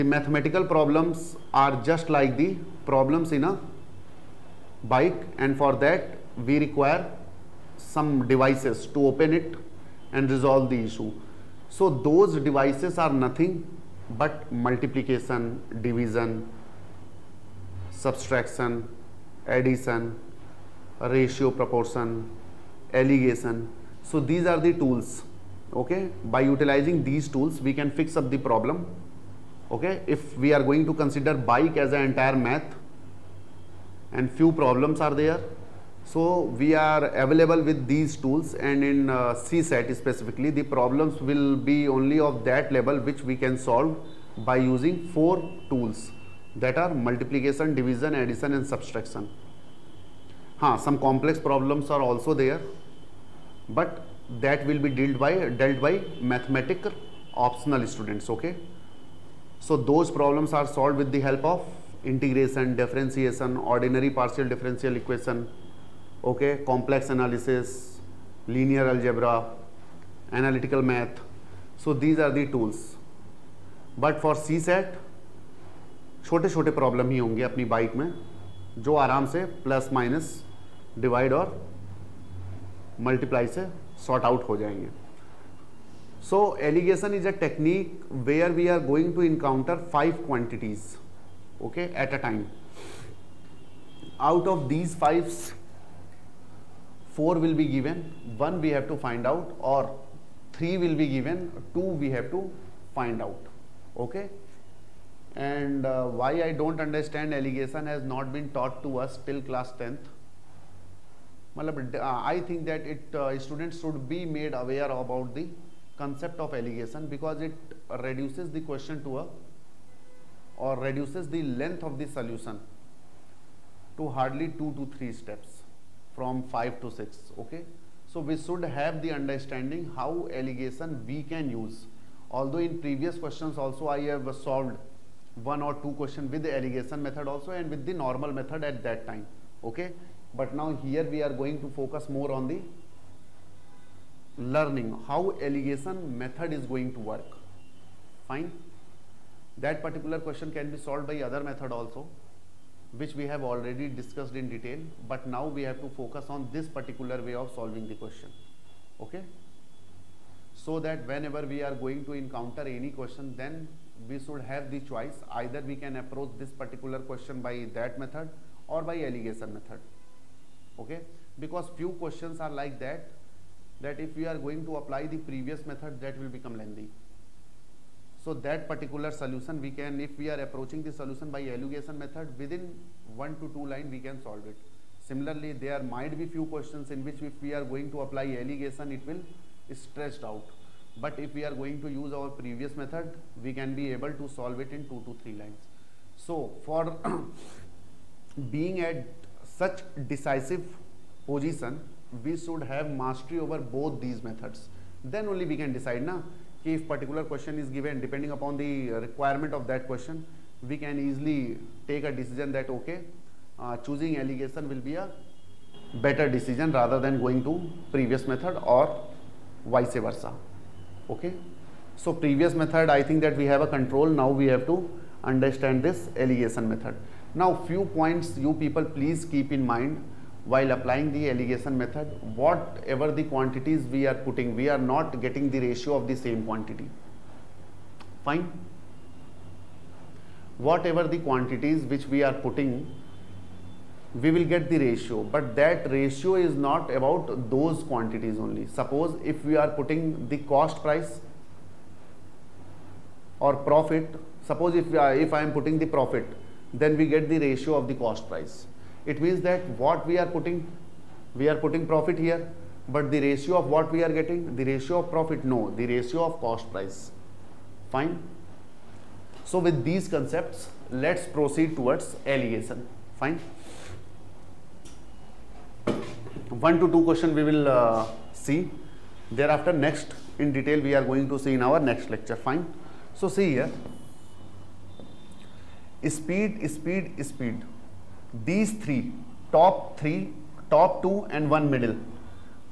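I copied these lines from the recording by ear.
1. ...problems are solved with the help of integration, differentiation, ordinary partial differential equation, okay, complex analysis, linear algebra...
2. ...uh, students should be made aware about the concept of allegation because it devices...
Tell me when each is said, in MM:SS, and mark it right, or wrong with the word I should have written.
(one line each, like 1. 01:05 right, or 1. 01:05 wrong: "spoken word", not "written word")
1. 01:00 right
2. 01:53 wrong: "reduces", not "devices".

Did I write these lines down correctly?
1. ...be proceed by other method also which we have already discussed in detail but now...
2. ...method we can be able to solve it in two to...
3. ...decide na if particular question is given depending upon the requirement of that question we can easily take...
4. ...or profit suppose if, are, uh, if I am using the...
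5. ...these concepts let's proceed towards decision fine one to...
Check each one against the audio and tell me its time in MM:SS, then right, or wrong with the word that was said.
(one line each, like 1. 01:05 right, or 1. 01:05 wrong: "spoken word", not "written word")
1. 02:30 wrong: "solved", not "proceed"
2. 03:12 right
3. 03:25 right
4. 04:13 wrong: "putting", not "using"
5. 04:29 wrong: "allegation", not "decision".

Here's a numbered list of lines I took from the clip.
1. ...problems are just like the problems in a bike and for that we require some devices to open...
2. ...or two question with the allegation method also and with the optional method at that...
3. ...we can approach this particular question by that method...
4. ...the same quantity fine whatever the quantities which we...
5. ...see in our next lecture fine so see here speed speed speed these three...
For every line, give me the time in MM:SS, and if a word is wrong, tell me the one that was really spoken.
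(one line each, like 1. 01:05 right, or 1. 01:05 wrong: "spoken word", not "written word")
1. 00:00 right
2. 02:15 wrong: "normal", not "optional"
3. 02:45 right
4. 03:56 right
5. 04:41 right.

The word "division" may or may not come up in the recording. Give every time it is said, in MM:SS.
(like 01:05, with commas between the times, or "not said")
00:15, 00:47.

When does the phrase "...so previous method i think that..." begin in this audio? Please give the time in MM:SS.
03:41.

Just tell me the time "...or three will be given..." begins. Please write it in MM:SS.
01:39.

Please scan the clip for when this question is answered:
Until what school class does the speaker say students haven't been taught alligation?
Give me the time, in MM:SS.
01:49.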